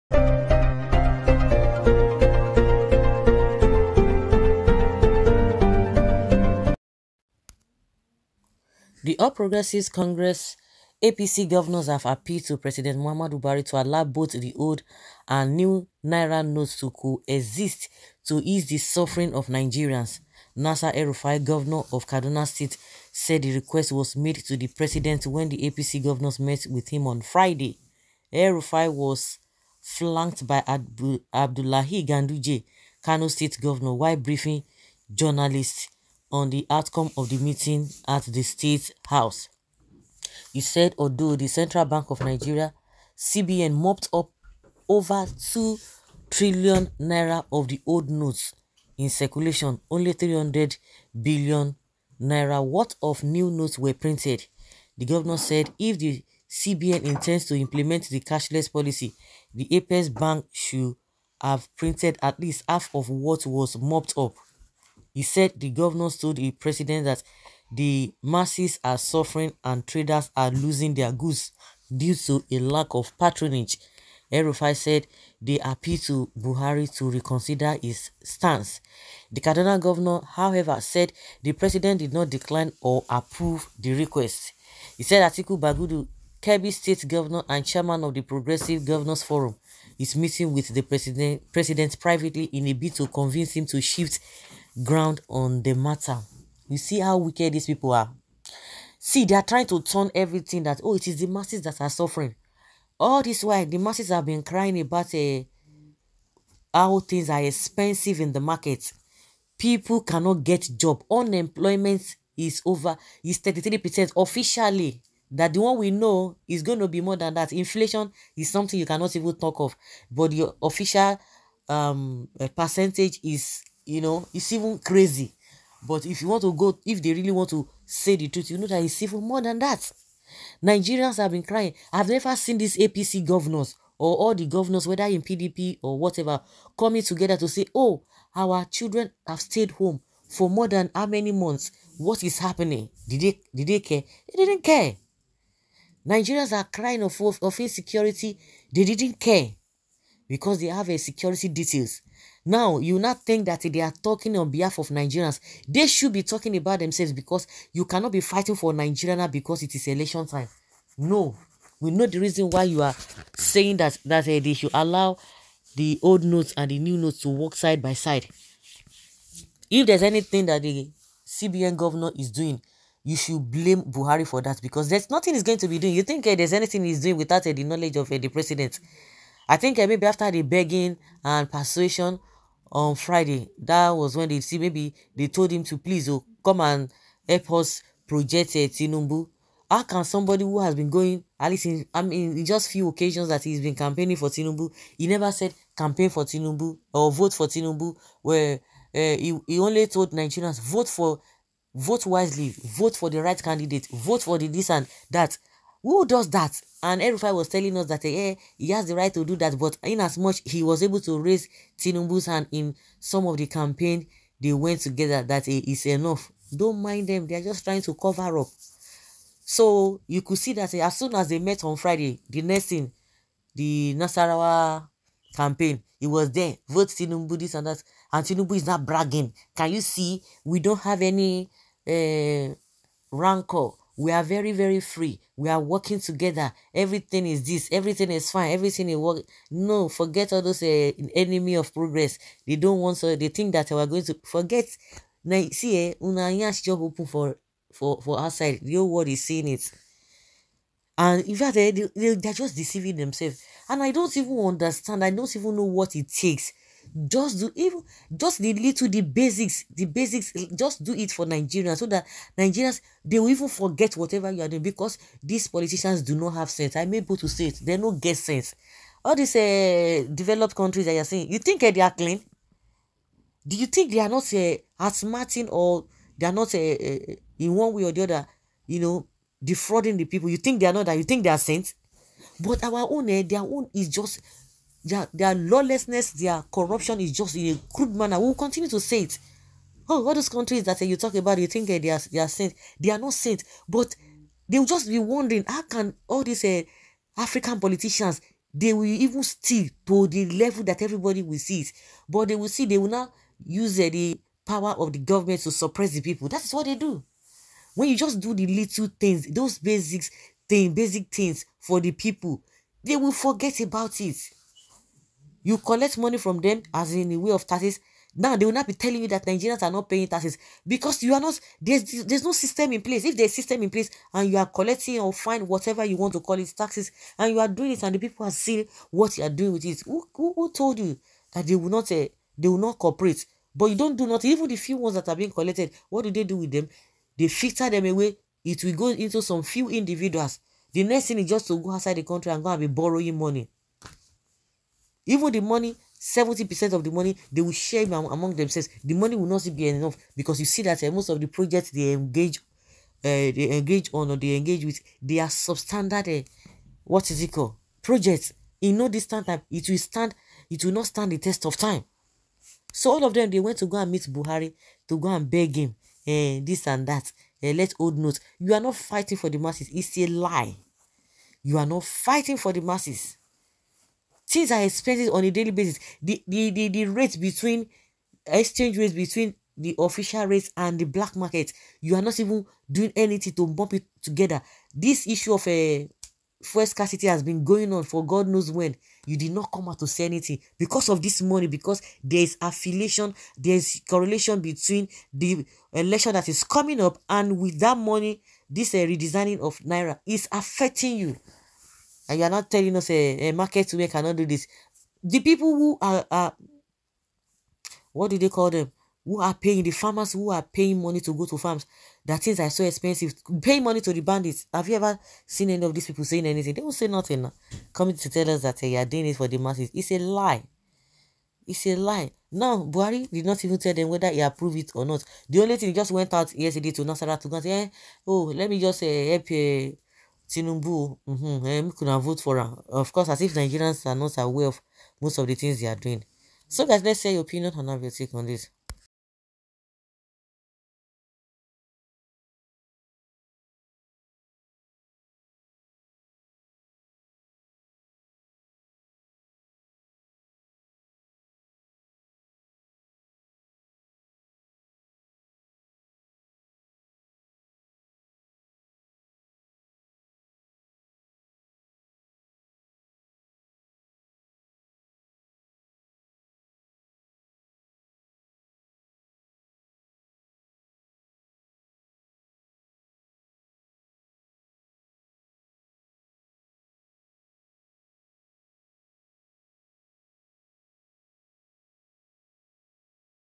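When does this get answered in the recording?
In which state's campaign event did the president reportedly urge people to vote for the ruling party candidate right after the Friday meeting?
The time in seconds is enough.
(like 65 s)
223 s.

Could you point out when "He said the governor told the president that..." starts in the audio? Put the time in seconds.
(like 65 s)
65 s.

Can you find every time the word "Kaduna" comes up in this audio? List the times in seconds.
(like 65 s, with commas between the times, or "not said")
22 s, 79 s.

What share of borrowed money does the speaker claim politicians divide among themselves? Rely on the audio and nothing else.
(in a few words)
70%.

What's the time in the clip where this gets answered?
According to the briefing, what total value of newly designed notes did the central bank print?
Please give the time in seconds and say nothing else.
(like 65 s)
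50 s.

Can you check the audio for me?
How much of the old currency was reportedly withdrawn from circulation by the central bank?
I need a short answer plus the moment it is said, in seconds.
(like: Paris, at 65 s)
over 2 trillion naira, at 44 s.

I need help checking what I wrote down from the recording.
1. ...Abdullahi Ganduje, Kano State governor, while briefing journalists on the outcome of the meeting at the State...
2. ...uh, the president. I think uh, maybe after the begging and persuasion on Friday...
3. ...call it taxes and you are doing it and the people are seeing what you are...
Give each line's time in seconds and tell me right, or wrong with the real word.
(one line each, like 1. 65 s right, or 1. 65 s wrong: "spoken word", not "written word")
1. 31 s right
2. 178 s right
3. 326 s right.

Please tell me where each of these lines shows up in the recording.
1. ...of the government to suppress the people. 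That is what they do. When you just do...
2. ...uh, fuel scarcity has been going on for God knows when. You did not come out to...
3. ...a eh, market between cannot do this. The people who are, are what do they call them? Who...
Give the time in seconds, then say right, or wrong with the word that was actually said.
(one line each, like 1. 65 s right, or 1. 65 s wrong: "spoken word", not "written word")
1. 304 s right
2. 385 s right
3. 403 s wrong: "women", not "between".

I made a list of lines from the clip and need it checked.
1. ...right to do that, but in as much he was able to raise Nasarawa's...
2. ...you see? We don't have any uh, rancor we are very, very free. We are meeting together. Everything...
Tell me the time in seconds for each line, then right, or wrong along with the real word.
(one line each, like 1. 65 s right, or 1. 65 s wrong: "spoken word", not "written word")
1. 208 s wrong: "Tinubu", not "Nasarawa"
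2. 229 s wrong: "working", not "meeting".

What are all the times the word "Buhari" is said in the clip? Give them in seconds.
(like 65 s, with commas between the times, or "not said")
13 s, 76 s, 173 s, 364 s, 422 s.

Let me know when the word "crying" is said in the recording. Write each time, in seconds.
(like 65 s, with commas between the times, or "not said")
104 s, 131 s, 146 s.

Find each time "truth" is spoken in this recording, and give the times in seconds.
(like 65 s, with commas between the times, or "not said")
128 s.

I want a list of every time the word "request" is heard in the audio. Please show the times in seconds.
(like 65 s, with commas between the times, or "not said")
23 s, 83 s.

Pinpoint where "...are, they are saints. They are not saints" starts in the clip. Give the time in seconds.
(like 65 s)
291 s.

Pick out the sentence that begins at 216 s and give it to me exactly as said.
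Don't mind them; they are just trying to cover up.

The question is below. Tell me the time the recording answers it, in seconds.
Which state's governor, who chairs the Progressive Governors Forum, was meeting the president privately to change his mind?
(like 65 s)
86 s.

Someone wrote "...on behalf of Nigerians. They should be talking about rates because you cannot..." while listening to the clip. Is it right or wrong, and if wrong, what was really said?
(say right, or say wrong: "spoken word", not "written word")
wrong: "themselves", not "rates".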